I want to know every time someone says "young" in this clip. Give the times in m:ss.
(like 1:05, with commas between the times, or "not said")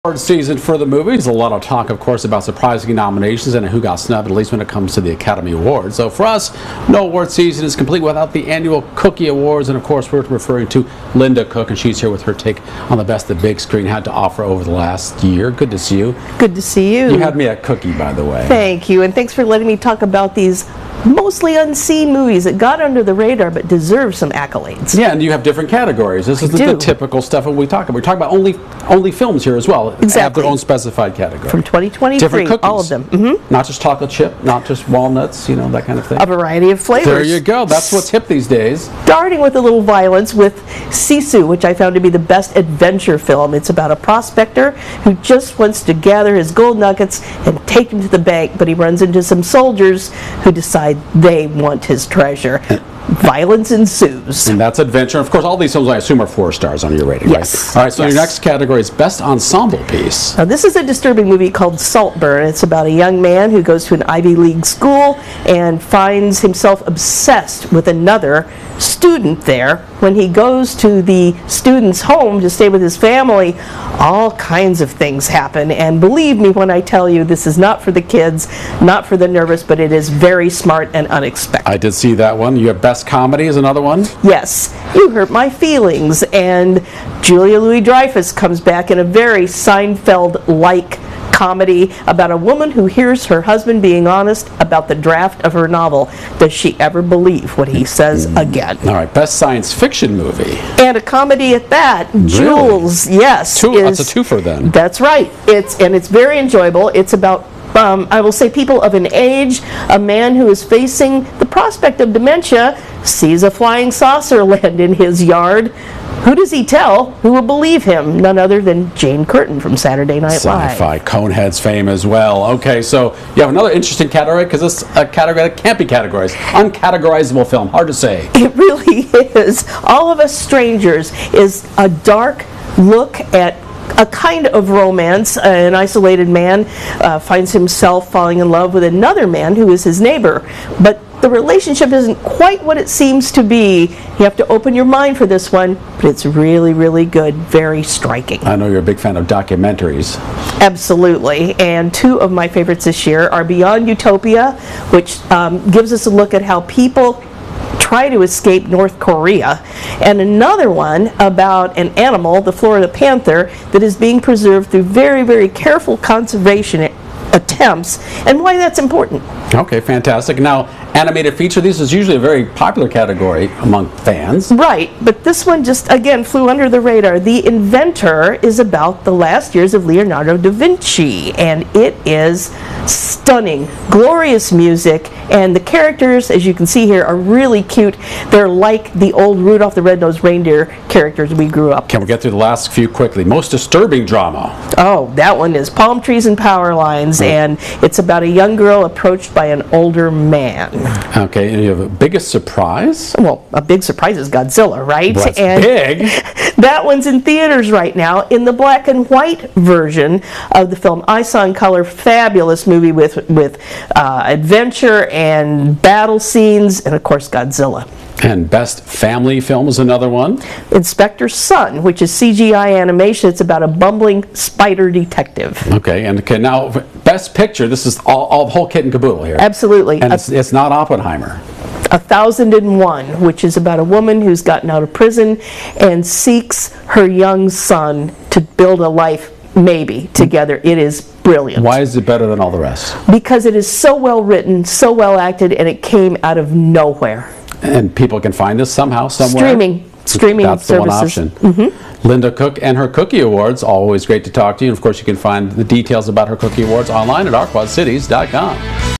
1:02, 3:18, 3:57.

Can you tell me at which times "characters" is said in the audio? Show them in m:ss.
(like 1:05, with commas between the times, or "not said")
3:05, 3:10.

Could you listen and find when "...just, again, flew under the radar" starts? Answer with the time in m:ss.
2:55.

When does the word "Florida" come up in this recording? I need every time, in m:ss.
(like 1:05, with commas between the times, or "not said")
2:42.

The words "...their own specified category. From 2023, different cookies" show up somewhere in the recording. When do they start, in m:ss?
0:30.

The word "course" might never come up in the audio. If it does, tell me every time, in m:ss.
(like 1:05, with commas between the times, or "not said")
0:01, 0:09, 0:55, 3:37, 4:14.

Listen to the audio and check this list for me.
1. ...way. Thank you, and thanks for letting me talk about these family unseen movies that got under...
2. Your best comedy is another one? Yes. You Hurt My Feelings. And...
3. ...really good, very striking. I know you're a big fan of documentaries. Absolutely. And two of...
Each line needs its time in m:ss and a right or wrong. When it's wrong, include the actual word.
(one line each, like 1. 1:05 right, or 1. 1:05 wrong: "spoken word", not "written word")
1. 0:18 wrong: "mostly", not "family"
2. 1:22 right
3. 2:26 right.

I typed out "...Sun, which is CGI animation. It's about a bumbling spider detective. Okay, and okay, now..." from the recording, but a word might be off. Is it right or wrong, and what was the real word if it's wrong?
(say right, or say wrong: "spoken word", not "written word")
right.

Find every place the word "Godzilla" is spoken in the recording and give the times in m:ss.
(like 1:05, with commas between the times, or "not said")
3:24, 3:37.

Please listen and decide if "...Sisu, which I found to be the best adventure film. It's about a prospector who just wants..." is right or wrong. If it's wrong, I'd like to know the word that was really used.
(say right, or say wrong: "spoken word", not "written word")
right.